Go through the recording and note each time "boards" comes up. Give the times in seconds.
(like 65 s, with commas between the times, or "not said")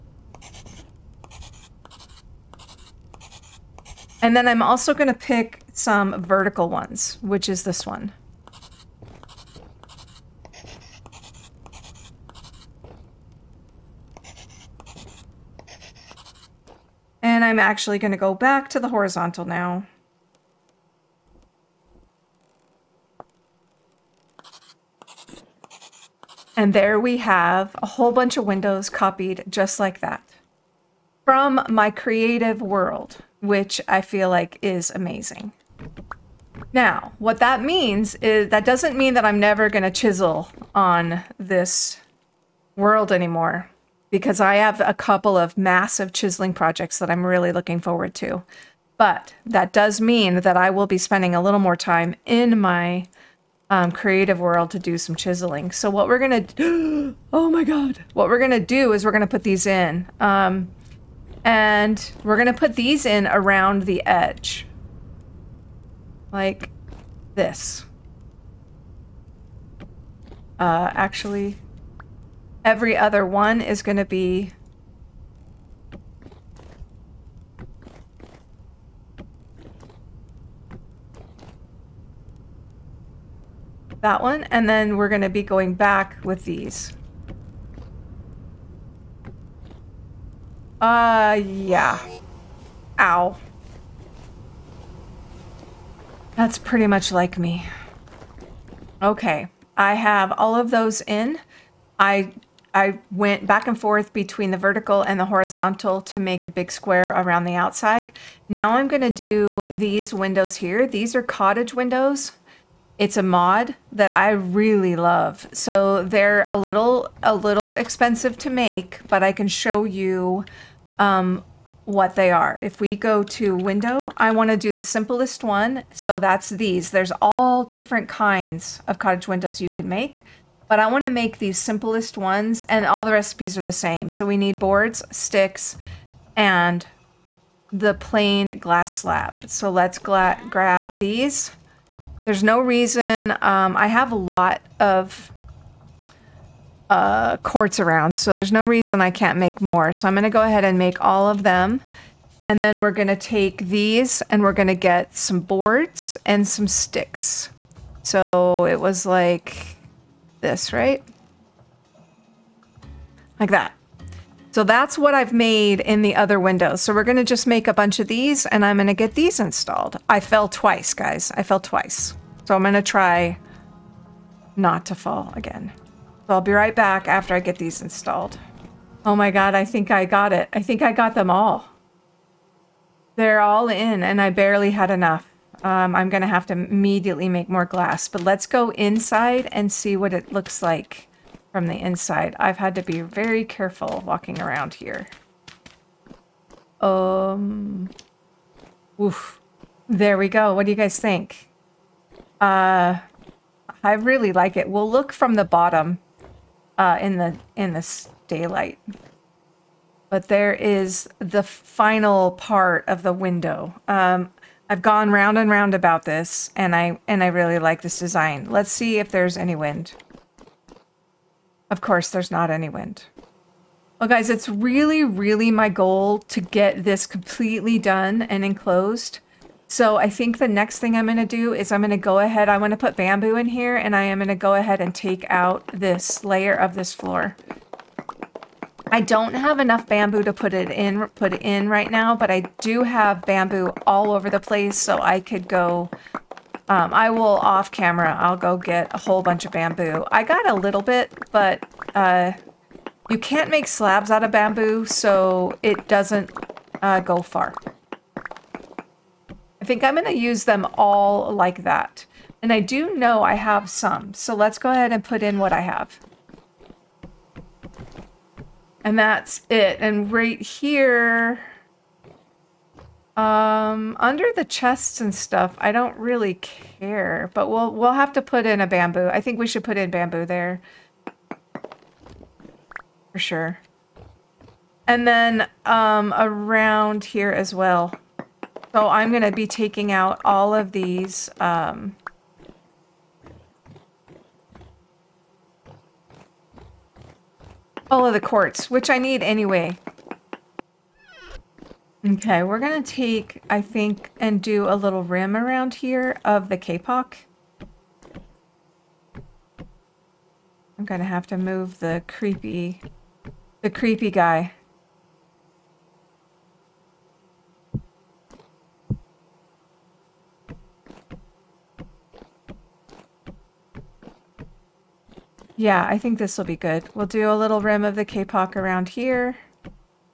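134 s, 155 s.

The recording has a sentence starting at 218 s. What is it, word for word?
Let's see if there's any wind.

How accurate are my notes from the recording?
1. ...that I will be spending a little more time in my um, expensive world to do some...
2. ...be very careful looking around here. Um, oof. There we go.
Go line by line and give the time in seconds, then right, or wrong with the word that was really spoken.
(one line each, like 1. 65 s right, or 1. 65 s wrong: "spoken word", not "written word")
1. 50 s wrong: "creative", not "expensive"
2. 192 s wrong: "walking", not "looking".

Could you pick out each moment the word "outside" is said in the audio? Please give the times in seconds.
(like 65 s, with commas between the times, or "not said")
107 s.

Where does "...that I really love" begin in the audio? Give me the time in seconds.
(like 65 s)
113 s.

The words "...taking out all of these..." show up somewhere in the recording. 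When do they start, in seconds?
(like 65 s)
289 s.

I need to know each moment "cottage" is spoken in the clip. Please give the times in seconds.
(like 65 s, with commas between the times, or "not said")
111 s, 128 s.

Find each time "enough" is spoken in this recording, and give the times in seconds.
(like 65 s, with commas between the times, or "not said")
184 s, 239 s.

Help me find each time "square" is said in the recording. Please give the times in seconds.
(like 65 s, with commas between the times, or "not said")
106 s.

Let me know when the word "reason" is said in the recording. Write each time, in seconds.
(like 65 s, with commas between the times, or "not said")
142 s, 148 s.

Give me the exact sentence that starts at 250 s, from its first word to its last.
I got a little bit, but uh, you can't make slabs out of bamboo, so it doesn't uh, go far.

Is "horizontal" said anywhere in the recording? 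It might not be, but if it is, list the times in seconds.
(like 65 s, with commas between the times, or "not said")
18 s, 105 s.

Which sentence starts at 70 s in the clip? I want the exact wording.
Uh, actually, every other one is going to be that one, and then we're going to be going back with these.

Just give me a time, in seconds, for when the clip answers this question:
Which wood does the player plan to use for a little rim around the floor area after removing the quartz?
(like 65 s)
306 s.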